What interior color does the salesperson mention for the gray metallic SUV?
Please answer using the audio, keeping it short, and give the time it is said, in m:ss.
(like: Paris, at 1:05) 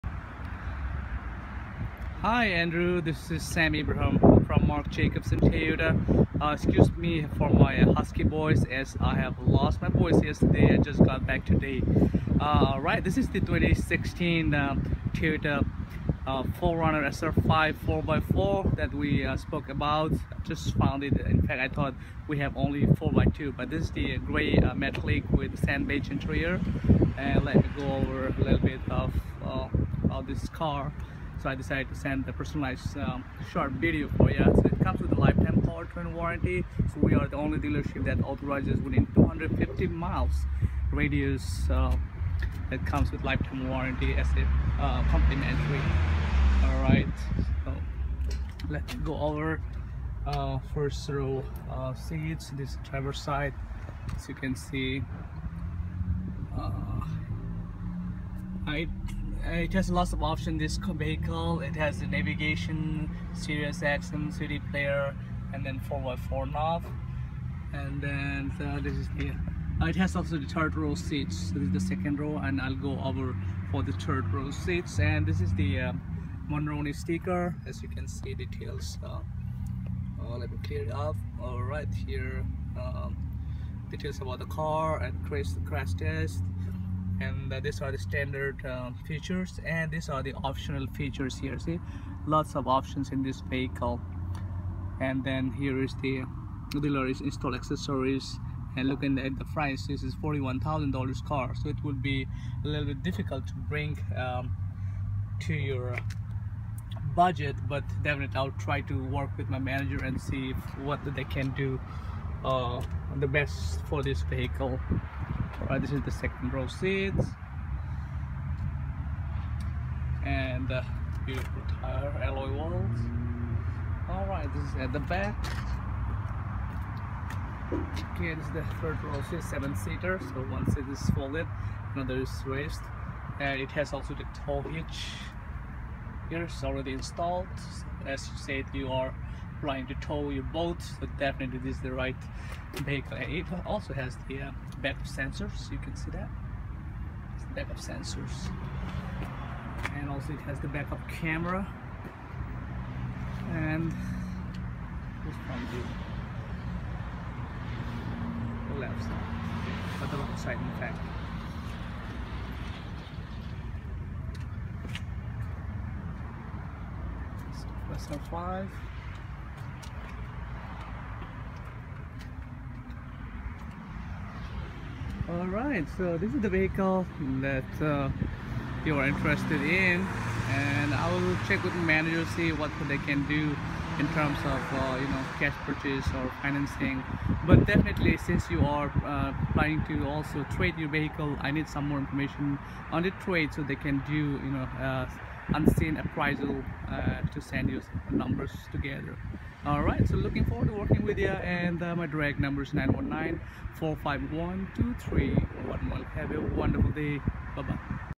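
Sand beige, at 0:25.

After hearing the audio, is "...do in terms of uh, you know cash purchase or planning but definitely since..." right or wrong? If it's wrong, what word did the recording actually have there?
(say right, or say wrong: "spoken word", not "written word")
wrong: "financing", not "planning".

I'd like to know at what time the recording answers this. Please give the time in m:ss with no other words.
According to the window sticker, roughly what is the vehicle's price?
1:40.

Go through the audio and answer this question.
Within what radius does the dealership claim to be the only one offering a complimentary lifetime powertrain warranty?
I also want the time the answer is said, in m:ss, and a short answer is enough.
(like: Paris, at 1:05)
250 miles, at 0:39.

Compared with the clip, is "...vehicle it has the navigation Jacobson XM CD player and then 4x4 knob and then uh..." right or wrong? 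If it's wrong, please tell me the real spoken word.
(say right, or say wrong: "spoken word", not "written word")
wrong: "Sirius", not "Jacobson".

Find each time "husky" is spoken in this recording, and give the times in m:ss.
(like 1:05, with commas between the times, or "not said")
0:07.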